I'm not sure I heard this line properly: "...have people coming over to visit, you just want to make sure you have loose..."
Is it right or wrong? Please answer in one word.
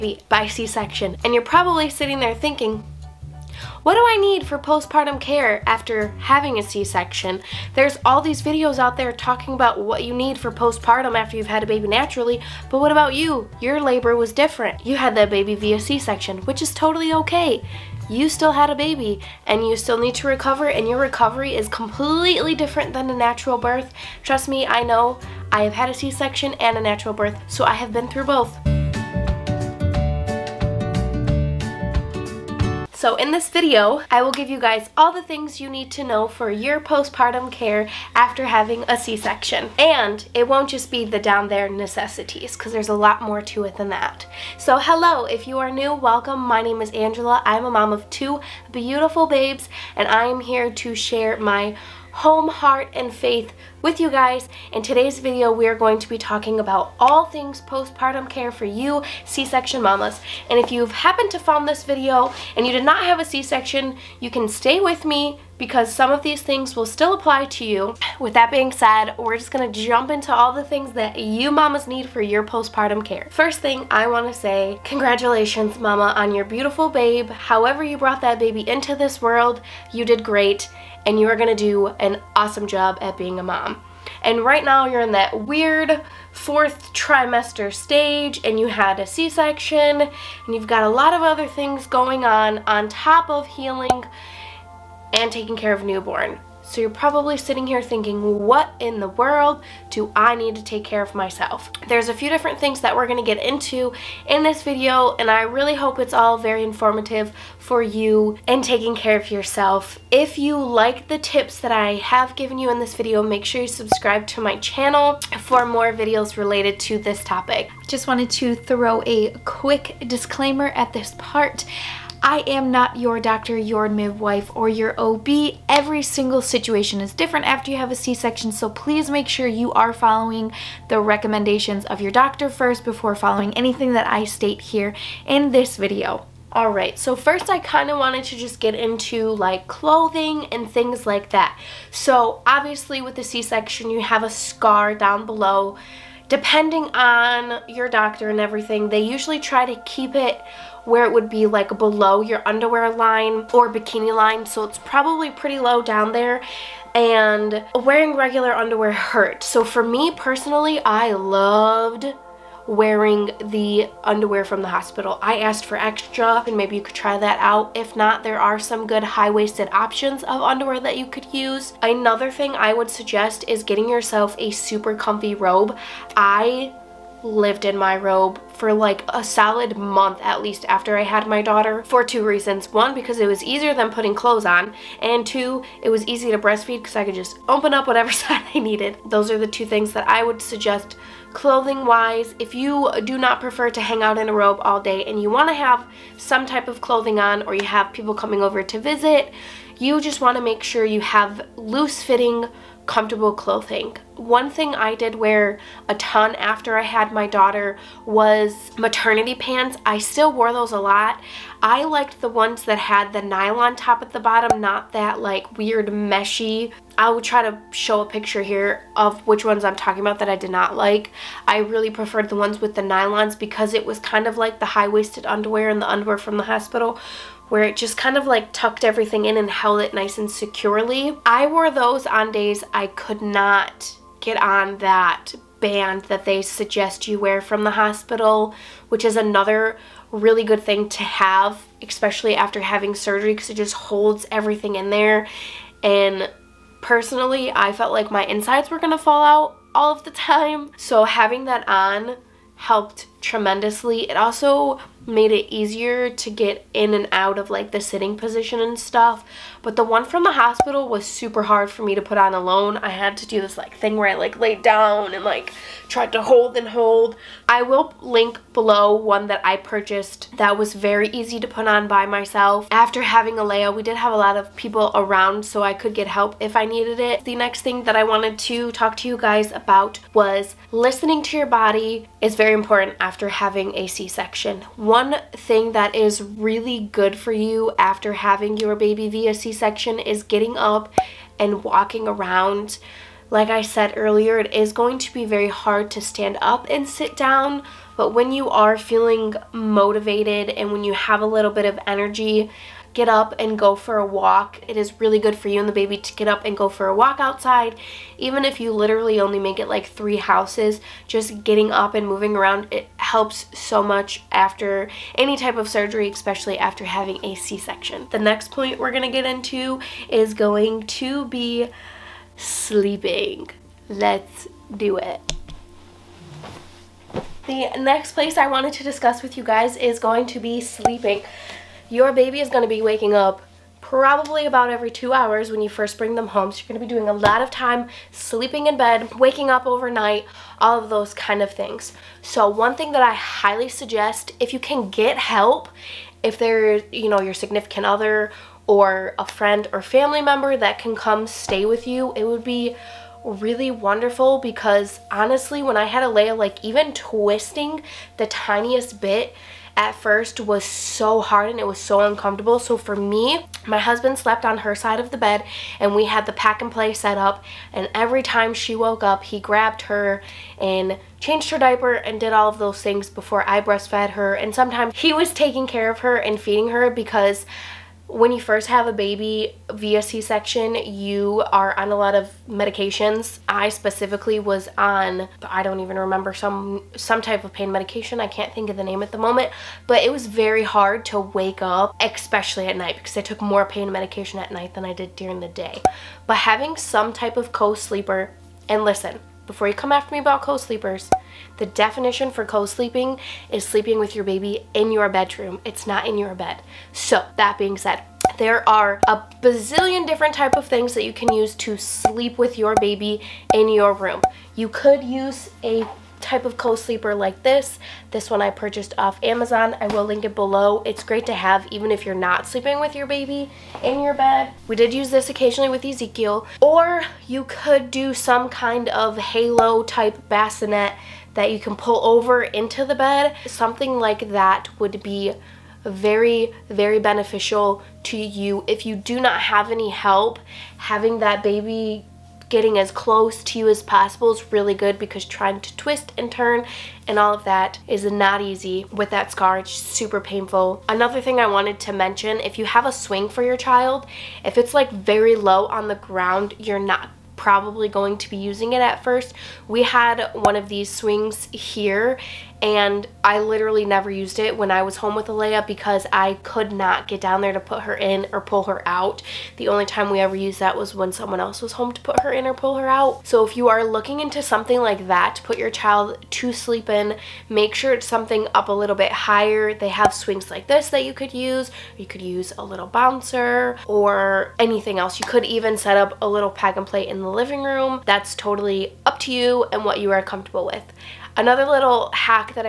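right.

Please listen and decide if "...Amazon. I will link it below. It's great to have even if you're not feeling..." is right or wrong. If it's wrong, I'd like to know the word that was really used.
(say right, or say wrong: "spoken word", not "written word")
wrong: "sleeping", not "feeling".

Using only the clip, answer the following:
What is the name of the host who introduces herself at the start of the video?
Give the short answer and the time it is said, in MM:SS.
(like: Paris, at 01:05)
Angela, at 00:46.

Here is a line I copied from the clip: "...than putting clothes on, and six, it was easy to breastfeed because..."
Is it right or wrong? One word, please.
wrong.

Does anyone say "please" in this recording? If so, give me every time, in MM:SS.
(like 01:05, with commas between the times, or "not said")
02:08.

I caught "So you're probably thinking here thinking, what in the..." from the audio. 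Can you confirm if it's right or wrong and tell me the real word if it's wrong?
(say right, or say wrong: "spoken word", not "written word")
wrong: "sitting", not "thinking".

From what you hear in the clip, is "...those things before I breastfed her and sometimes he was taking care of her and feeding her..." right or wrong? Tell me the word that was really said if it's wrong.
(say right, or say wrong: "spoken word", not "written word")
right.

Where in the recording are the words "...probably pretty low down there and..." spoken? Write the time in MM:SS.
02:34.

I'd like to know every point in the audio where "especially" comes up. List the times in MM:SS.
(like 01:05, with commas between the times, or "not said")
04:01, 05:16, 06:32.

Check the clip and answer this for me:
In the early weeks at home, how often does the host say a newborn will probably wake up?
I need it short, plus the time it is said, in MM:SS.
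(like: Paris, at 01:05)
Every 2 hours, at 05:34.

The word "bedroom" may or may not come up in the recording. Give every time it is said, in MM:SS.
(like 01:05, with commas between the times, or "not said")
06:45.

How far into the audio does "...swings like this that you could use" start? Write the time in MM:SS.
08:00.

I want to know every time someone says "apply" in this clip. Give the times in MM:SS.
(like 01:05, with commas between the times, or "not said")
01:07.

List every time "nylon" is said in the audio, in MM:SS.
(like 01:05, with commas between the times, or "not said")
03:33, 03:42.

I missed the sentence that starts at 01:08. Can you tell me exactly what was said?
With that being said, we're just gonna jump into all the things that you mamas need for your postpartum care.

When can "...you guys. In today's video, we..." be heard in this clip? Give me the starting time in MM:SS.
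00:53.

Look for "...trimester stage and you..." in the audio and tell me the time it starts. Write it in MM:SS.
01:26.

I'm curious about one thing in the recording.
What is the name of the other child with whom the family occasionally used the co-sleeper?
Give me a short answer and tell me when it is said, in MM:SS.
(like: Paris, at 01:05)
Ezekiel, at 07:05.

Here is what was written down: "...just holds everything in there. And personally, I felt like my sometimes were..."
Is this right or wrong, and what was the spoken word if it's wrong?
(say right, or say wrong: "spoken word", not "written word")
wrong: "insides", not "sometimes".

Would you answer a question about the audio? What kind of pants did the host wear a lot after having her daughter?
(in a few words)
Maternity pants.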